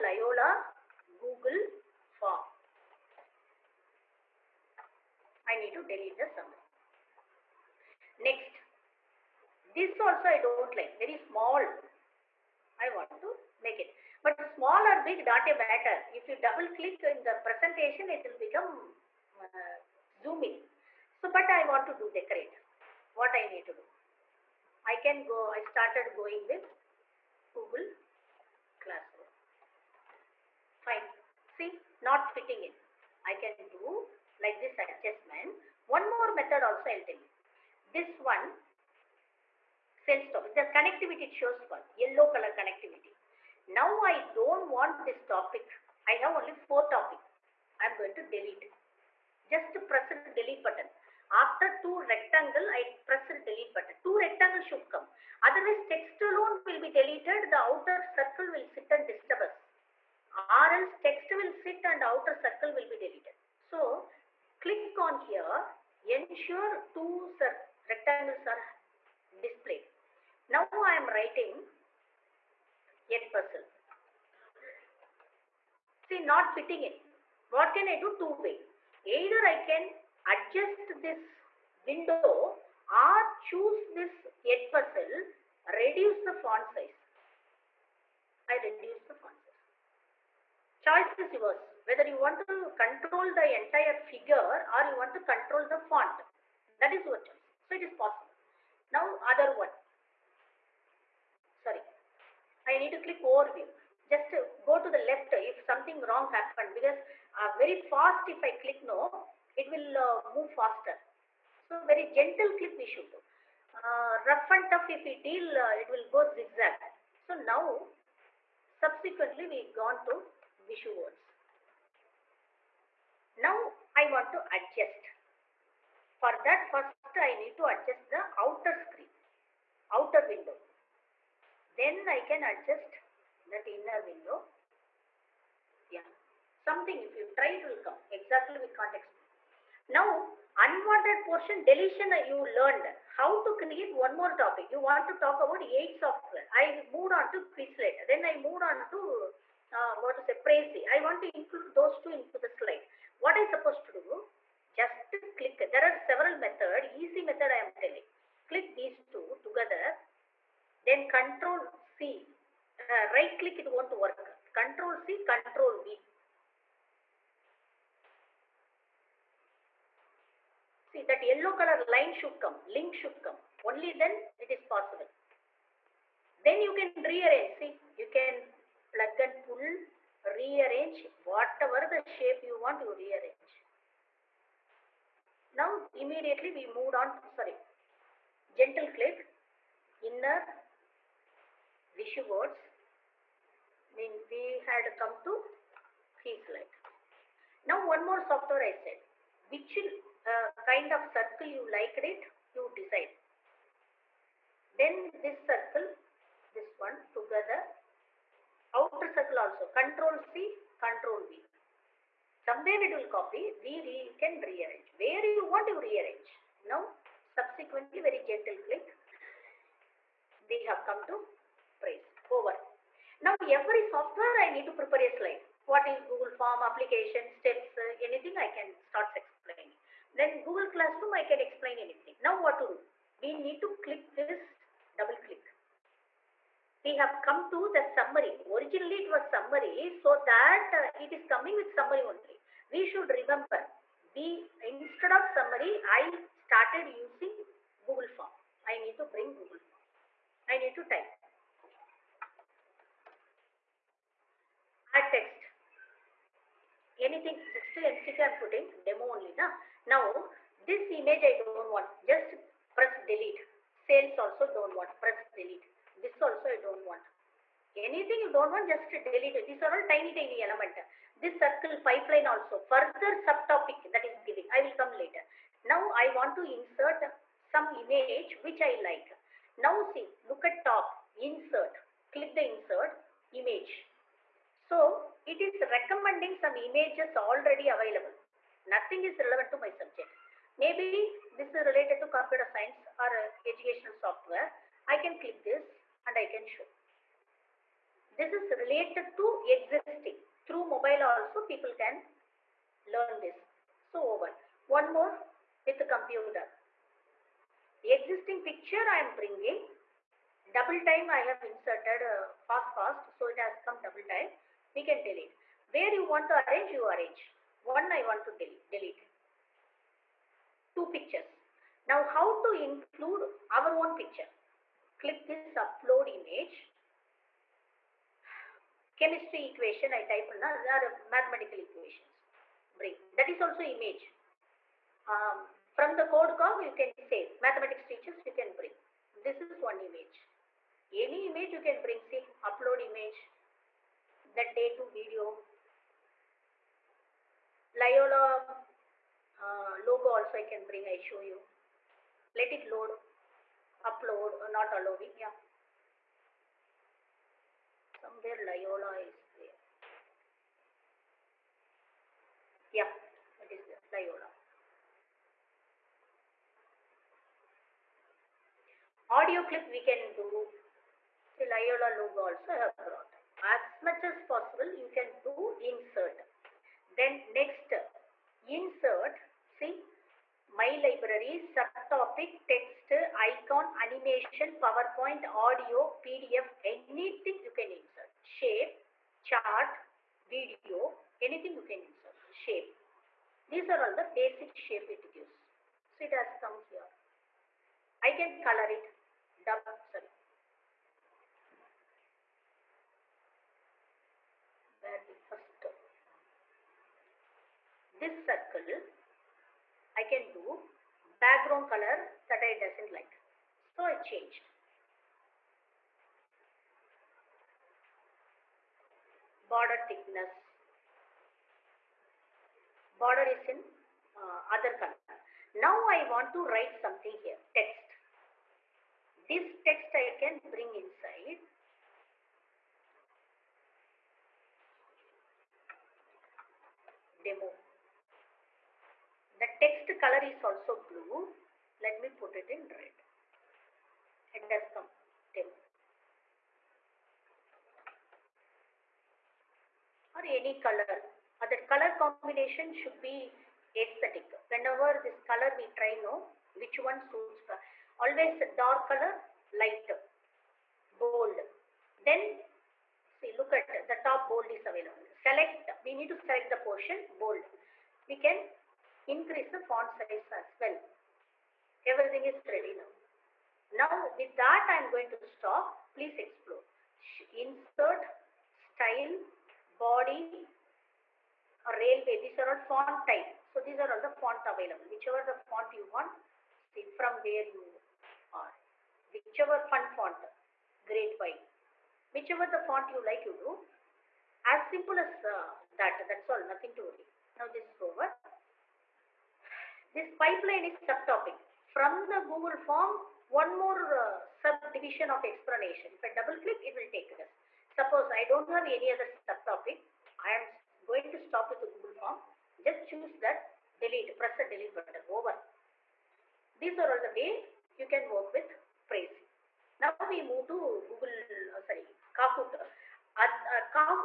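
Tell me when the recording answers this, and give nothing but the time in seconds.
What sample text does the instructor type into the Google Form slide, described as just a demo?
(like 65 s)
257 s.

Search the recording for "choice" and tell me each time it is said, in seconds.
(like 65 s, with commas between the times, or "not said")
90 s, 97 s.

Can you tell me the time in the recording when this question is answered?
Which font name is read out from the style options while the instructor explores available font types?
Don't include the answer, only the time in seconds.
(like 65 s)
481 s.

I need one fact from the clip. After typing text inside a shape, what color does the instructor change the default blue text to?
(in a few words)
red.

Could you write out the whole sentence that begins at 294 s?
I can click this and I can show.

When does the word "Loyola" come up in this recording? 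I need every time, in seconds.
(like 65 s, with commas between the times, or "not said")
347 s, 358 s, 363 s, 371 s.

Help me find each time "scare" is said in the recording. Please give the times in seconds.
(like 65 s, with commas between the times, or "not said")
not said.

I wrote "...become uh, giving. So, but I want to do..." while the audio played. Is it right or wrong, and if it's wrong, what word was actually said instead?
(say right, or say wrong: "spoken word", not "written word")
wrong: "zooming", not "giving".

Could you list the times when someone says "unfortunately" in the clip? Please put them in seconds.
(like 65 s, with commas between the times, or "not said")
not said.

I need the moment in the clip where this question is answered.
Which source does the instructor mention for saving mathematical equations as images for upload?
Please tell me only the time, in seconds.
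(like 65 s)
336 s.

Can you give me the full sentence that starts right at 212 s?
Somewhere it will copy, we re can rearrange.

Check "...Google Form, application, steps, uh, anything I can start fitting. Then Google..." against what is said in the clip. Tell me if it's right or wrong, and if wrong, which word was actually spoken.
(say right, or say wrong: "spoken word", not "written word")
wrong: "explaining", not "fitting".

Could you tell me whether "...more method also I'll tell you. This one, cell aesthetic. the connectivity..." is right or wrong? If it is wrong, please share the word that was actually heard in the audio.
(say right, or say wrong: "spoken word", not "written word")
wrong: "topic", not "aesthetic".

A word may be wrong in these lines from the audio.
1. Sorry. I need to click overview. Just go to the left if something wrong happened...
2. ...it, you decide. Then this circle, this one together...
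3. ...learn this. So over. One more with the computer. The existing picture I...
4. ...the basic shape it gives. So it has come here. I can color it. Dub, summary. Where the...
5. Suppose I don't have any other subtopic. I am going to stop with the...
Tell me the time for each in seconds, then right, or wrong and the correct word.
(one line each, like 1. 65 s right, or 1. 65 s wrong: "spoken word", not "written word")
1. 101 s right
2. 201 s right
3. 302 s right
4. 393 s wrong: "sorry", not "summary"
5. 507 s right.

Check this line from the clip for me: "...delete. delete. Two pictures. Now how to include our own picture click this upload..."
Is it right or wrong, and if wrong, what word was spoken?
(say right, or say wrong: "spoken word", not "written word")
right.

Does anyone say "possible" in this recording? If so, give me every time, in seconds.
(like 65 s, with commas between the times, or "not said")
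97 s, 174 s, 374 s.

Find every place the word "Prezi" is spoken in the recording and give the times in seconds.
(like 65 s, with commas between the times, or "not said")
150 s, 221 s, 518 s.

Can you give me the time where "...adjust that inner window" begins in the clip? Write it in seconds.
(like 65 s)
132 s.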